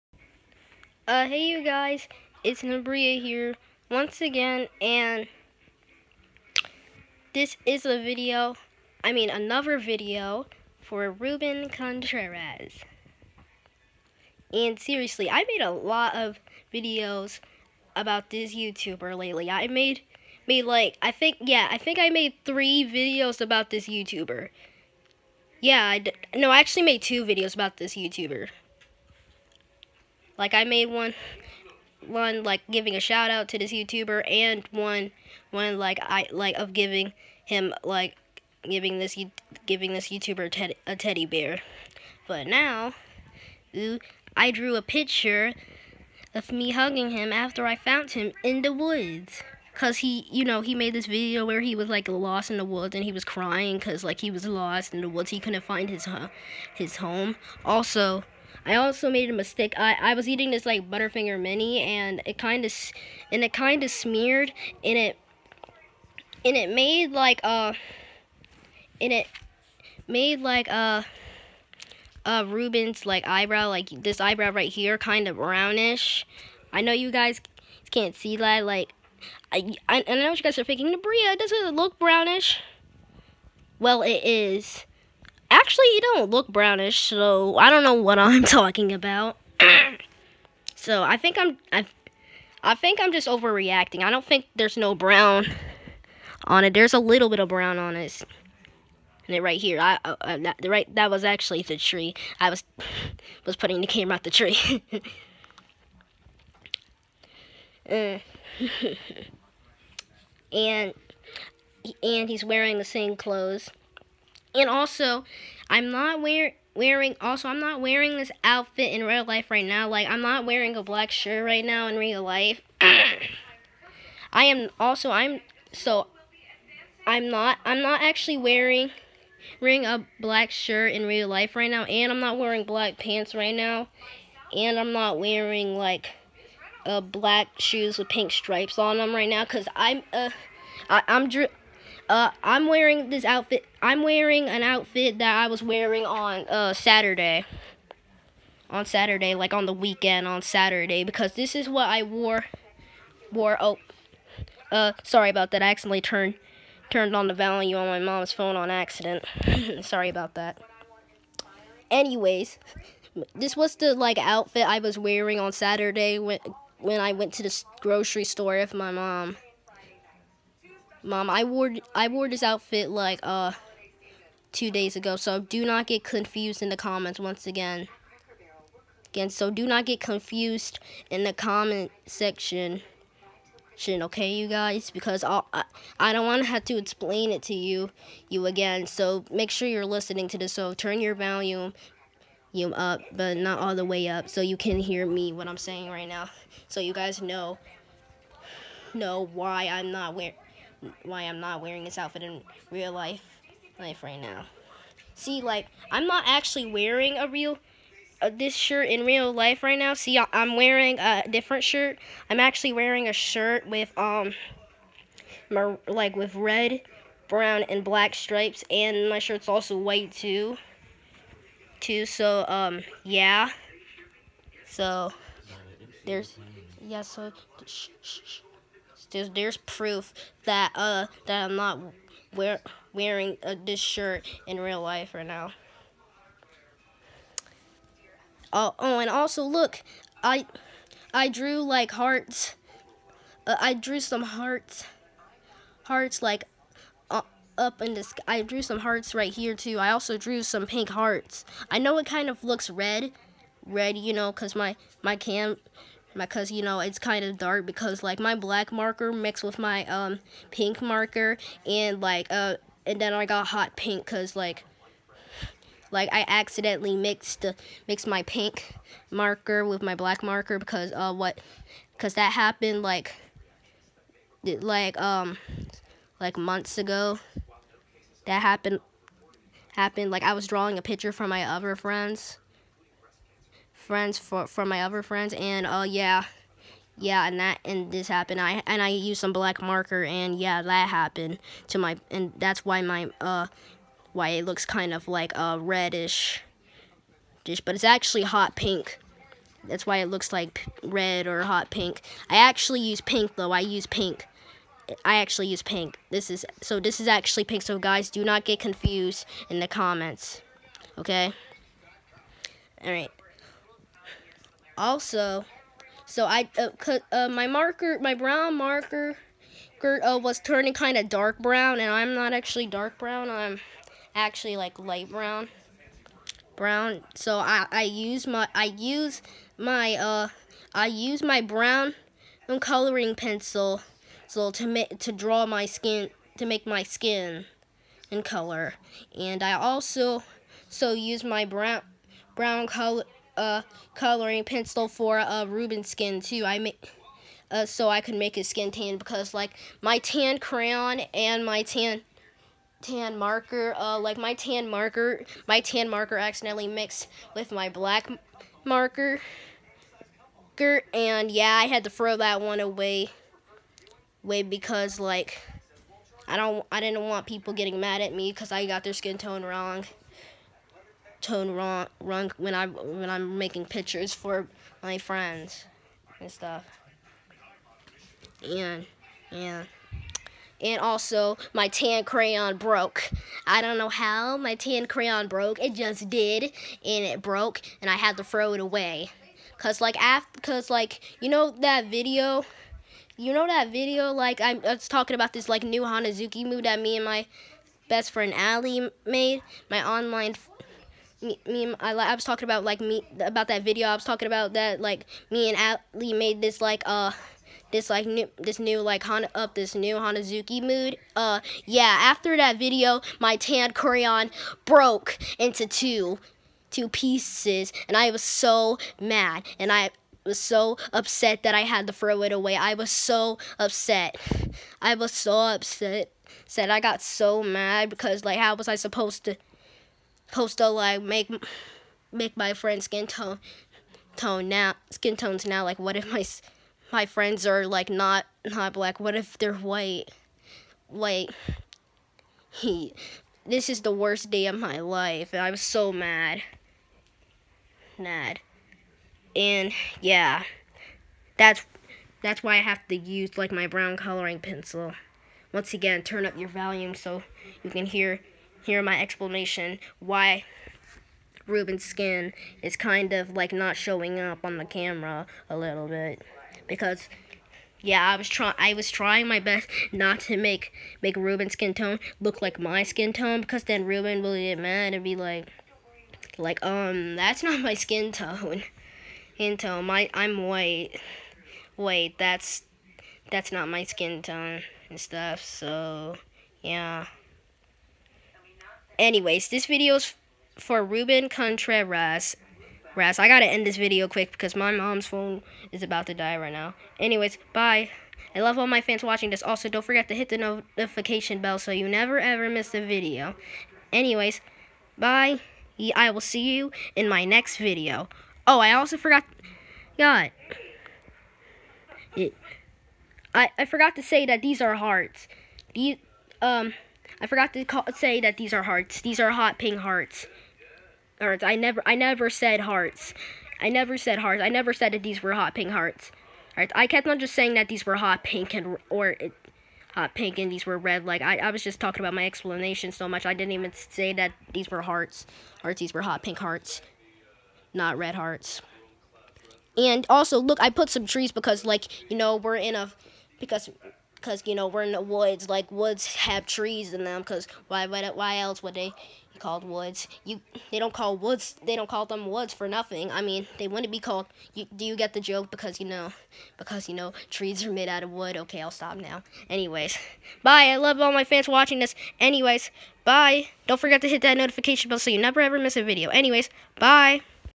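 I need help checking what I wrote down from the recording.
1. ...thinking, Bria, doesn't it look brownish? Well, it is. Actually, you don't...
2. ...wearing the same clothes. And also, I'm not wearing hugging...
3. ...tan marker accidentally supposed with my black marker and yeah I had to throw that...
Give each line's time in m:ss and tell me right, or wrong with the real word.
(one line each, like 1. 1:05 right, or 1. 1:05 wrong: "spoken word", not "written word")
1. 1:20 right
2. 1:52 wrong: "wearing", not "hugging"
3. 5:55 wrong: "mixed", not "supposed".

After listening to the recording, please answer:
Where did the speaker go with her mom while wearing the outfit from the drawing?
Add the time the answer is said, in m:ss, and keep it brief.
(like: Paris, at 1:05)
grocery store, at 2:47.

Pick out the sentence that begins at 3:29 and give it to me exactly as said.
See, I'm wearing a different shirt.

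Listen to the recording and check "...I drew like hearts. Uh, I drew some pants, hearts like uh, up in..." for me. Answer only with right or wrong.
wrong.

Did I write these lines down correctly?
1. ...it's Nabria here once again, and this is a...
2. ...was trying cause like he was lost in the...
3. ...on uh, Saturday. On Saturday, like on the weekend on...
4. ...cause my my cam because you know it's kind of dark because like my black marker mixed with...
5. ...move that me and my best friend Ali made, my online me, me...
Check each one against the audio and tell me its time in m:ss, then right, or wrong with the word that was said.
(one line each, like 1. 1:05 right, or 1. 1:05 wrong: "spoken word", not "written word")
1. 0:02 right
2. 0:53 wrong: "crying", not "trying"
3. 2:26 right
4. 4:14 right
5. 6:36 right.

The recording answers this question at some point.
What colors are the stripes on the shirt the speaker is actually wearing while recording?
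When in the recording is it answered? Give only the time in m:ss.
3:36.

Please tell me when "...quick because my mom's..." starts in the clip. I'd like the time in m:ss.
8:14.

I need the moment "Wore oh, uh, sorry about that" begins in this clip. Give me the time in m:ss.
2:33.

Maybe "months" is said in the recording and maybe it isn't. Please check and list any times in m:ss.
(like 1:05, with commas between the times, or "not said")
4:36.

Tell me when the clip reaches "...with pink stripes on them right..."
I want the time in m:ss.
2:17.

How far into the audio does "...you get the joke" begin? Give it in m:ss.
9:14.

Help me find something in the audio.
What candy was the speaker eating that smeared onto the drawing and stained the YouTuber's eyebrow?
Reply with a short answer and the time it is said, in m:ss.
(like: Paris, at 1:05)
Butterfinger mini, at 1:00.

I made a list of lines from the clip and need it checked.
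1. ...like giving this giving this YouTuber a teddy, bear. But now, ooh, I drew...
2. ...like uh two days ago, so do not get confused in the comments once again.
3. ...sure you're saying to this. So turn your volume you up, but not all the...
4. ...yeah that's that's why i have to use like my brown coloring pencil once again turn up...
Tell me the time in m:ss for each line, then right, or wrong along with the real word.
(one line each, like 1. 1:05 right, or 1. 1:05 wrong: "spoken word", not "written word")
1. 0:37 right
2. 2:52 right
3. 3:09 wrong: "listening", not "saying"
4. 7:30 right.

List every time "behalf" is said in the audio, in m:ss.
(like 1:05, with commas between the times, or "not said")
not said.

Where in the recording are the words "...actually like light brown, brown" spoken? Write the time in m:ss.
5:24.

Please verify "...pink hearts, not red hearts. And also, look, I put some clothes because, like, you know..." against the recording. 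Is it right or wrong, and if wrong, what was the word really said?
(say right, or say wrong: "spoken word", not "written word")
wrong: "trees", not "clothes".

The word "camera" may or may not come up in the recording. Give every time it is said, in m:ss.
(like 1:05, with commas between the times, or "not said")
1:43, 7:44.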